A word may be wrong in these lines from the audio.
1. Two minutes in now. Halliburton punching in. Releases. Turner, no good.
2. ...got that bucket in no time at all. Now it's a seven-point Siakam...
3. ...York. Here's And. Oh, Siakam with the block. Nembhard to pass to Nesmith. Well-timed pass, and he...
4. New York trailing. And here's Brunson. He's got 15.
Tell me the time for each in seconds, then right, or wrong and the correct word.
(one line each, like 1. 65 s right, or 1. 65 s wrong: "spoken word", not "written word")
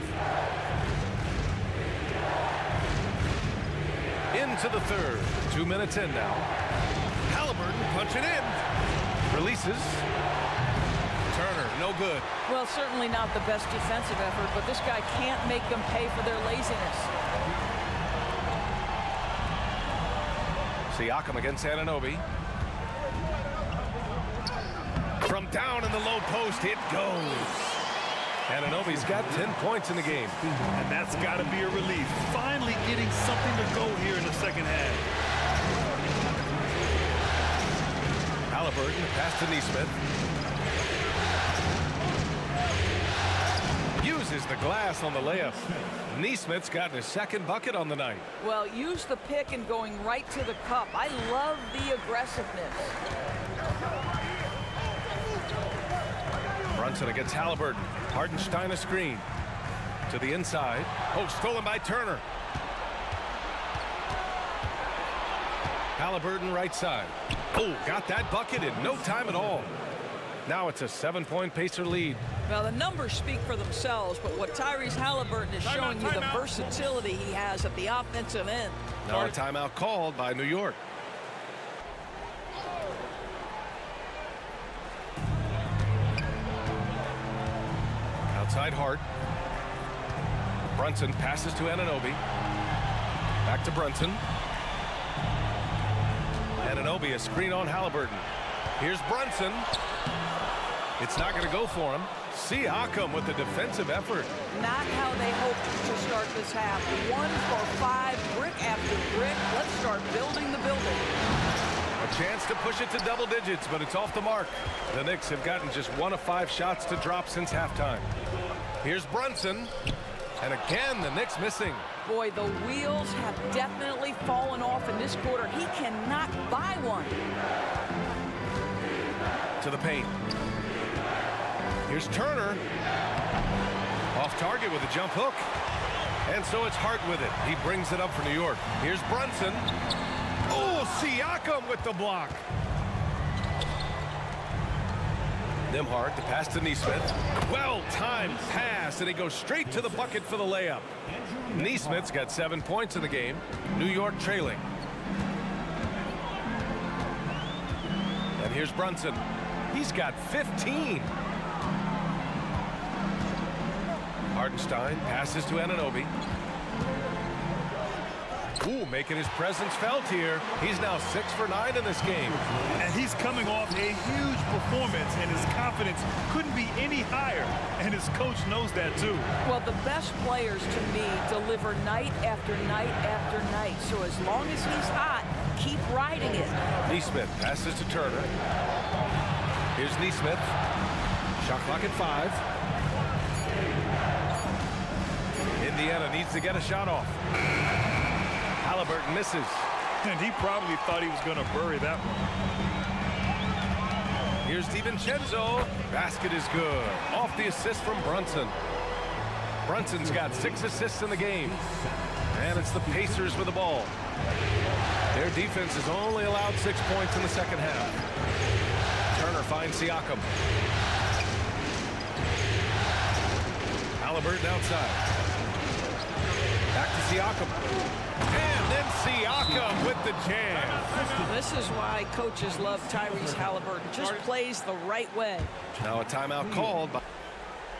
1. 5 s right
2. 67 s wrong: "Pacer", not "Siakam"
3. 138 s wrong: "Brunson", not "And"
4. 153 s right.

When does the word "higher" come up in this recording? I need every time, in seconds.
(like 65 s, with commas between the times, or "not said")
177 s.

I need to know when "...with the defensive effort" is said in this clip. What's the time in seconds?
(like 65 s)
103 s.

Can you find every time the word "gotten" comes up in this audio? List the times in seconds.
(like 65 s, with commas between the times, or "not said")
46 s, 115 s.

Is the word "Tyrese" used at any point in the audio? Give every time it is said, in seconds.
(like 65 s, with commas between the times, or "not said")
74 s, 232 s.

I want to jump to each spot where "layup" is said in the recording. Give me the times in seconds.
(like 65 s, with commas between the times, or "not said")
45 s, 150 s.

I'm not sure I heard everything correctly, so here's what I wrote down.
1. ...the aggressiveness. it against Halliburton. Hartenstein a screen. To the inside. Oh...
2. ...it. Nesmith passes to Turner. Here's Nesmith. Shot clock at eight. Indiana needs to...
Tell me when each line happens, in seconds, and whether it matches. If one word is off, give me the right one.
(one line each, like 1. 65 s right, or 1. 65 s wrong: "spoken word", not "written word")
1. 51 s right
2. 186 s wrong: "five", not "eight".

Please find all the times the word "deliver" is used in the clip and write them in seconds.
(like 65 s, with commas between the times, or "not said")
181 s.